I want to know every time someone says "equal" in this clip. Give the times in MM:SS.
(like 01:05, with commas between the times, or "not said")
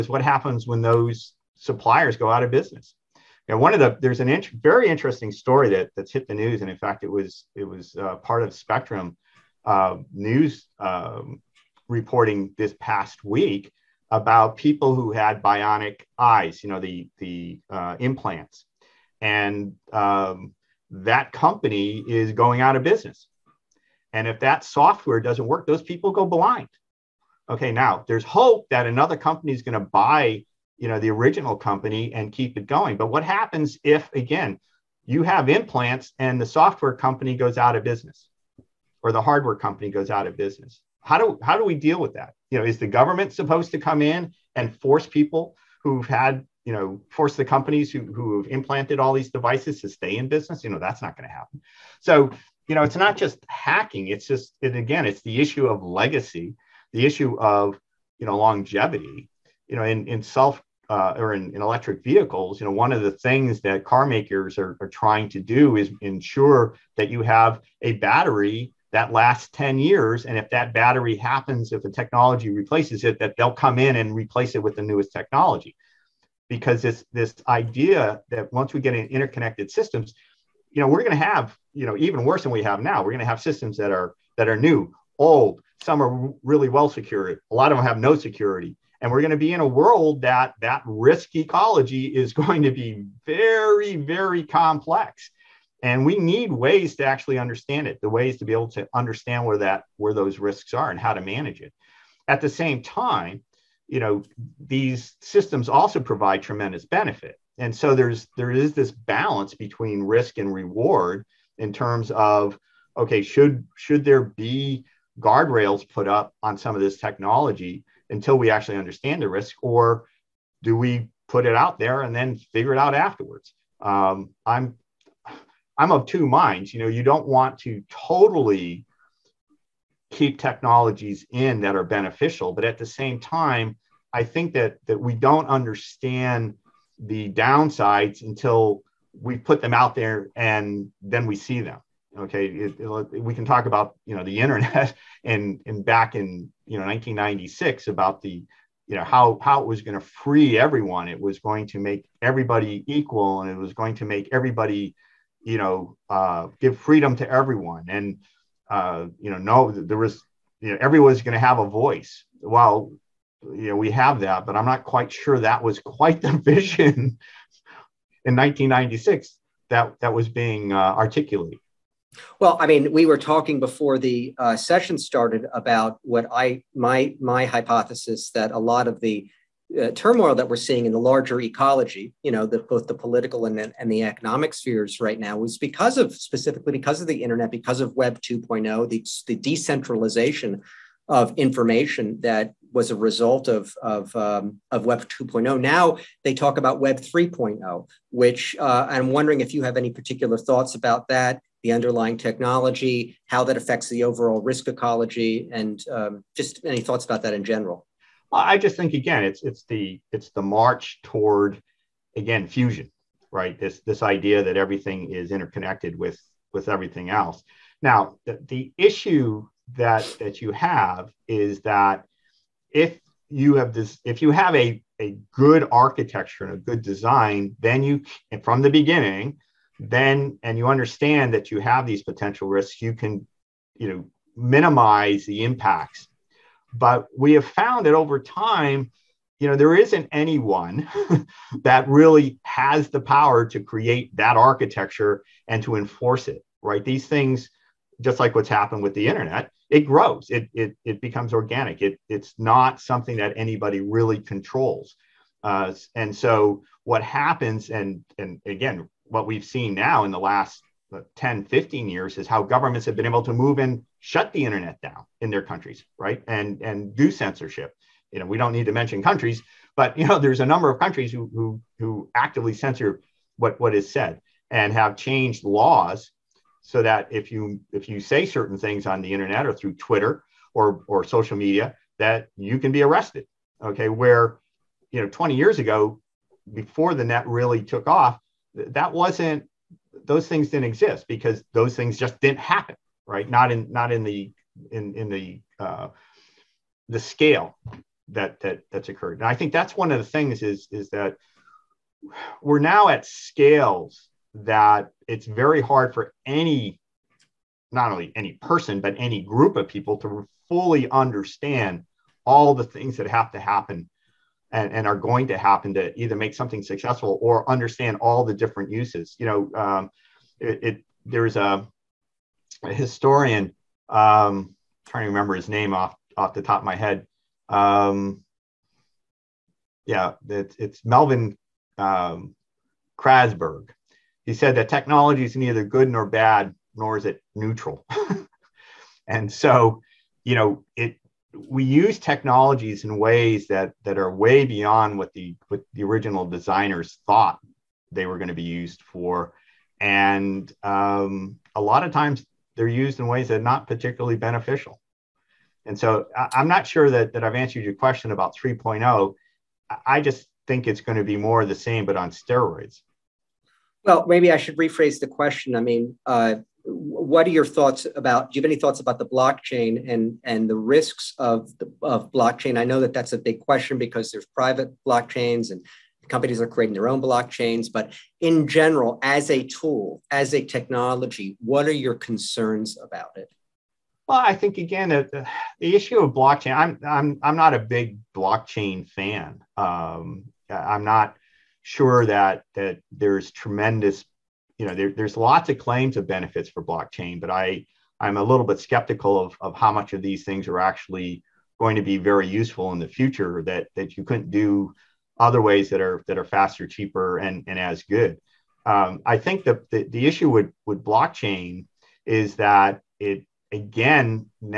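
02:32.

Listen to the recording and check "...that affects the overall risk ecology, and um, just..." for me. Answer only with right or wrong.
right.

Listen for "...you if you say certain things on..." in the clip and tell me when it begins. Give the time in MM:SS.
04:37.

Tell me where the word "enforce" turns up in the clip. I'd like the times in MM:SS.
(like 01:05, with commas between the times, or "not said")
04:05.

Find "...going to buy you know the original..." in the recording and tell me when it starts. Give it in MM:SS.
00:29.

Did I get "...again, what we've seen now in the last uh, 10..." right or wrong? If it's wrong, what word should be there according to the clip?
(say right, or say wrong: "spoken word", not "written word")
right.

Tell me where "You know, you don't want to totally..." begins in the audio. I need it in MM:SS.
02:06.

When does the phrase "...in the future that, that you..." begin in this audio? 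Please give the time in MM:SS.
06:42.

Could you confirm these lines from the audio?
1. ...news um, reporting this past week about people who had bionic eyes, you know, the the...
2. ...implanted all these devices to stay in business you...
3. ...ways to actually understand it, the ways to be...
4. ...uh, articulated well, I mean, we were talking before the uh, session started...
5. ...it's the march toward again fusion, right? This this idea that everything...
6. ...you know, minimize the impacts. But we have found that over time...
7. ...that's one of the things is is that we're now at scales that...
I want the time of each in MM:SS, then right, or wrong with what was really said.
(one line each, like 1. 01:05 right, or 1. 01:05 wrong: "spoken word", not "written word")
1. 00:10 right
2. 00:48 right
3. 01:36 right
4. 02:50 right
5. 03:30 right
6. 03:53 right
7. 04:59 right.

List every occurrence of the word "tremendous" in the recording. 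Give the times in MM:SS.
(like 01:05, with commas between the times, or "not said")
01:46, 06:33.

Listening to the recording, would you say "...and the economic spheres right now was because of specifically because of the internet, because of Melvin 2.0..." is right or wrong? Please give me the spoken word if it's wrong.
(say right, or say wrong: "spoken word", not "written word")
wrong: "Web", not "Melvin".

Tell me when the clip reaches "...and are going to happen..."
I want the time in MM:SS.
05:14.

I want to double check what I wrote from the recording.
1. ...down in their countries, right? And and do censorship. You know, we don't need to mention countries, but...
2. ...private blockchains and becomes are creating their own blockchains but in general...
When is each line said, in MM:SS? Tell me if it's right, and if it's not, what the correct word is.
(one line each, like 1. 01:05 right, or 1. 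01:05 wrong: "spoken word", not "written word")
1. 04:24 right
2. 06:14 wrong: "companies", not "becomes".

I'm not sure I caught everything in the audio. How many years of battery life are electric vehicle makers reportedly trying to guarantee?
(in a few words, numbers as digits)
10 years.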